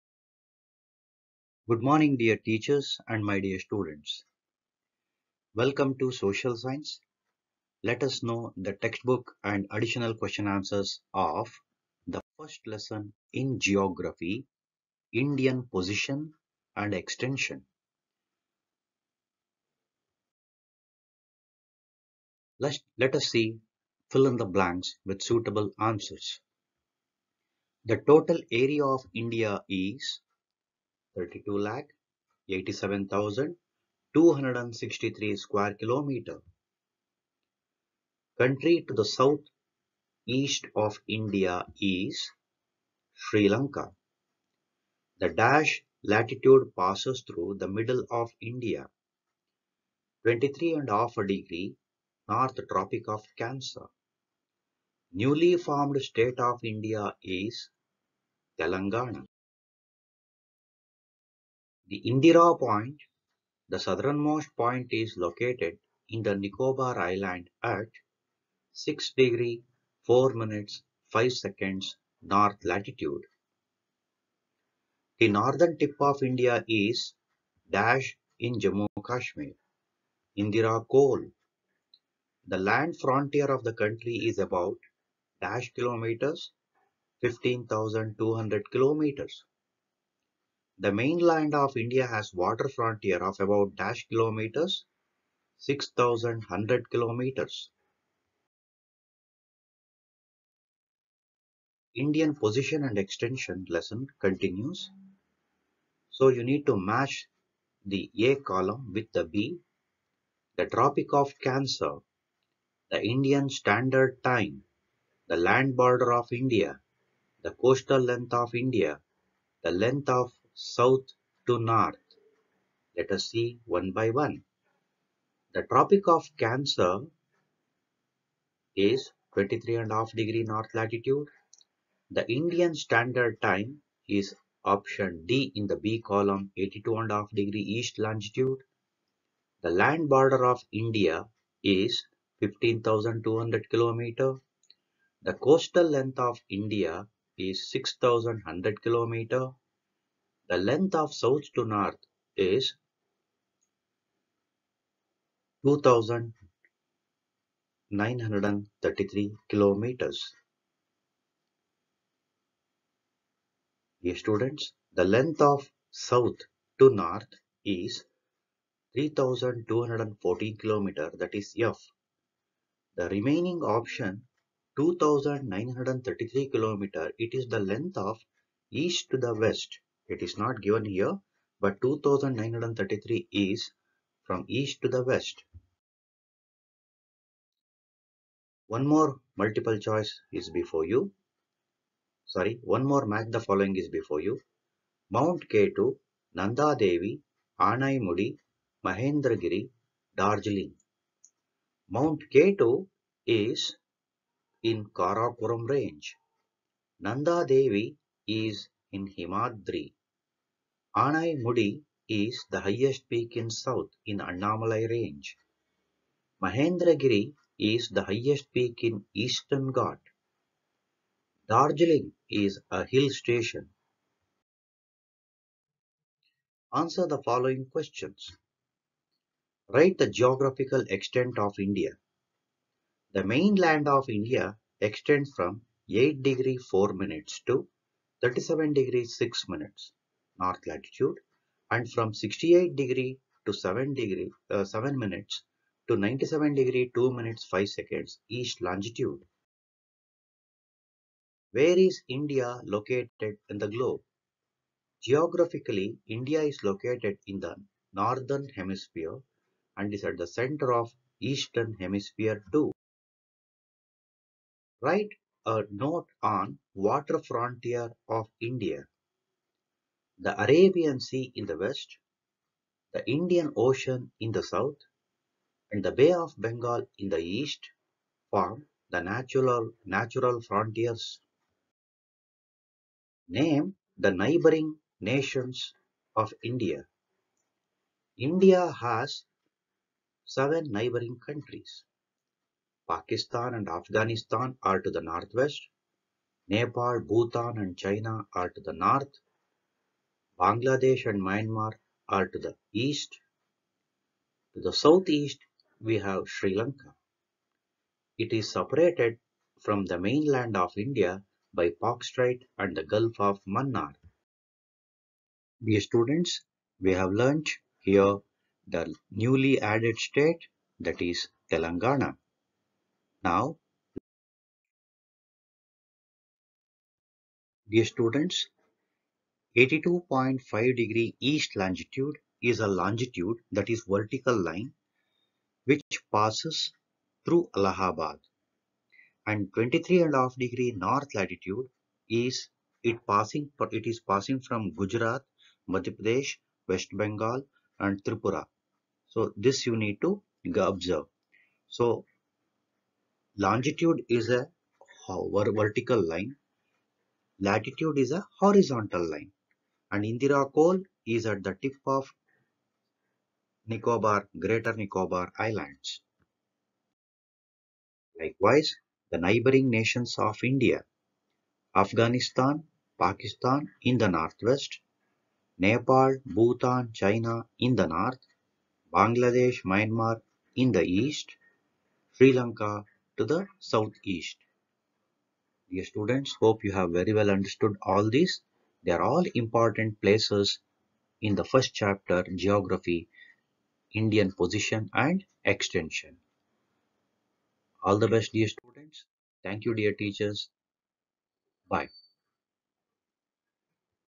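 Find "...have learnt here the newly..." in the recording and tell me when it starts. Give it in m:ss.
5:16.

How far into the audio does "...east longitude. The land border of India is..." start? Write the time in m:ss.
2:17.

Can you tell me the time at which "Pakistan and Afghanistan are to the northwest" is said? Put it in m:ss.
4:52.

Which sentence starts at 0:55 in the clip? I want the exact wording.
Newly formed state of India is Telangana.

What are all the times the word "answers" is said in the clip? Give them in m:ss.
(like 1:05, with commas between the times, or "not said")
0:10, 0:25, 3:46.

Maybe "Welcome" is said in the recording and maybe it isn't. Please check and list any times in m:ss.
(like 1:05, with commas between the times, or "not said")
0:05.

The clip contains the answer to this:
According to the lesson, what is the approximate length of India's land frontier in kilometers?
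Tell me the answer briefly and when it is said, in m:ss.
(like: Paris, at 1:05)
15,200 kilometers, at 1:27.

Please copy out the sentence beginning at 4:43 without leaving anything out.
Name the neighboring nations of India.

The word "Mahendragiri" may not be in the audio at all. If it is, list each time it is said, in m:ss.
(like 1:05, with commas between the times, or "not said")
3:18, 3:36.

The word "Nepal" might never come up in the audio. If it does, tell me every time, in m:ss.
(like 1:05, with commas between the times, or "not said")
4:56, 6:15.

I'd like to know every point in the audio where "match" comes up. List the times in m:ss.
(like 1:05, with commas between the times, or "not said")
1:46, 3:13.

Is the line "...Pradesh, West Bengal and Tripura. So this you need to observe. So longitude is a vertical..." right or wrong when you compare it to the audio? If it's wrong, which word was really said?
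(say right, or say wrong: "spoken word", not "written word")
right.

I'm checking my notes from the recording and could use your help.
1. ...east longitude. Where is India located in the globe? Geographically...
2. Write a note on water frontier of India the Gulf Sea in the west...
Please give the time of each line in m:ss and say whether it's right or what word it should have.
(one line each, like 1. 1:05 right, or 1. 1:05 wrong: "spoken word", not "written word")
1. 4:08 right
2. 4:24 wrong: "Arabian", not "Gulf".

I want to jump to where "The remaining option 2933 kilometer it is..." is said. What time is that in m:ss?
2:52.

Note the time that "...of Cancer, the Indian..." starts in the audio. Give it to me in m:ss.
1:51.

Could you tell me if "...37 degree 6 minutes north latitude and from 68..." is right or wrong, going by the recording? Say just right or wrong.
right.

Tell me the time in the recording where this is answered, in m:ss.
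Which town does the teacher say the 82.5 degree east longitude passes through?
5:37.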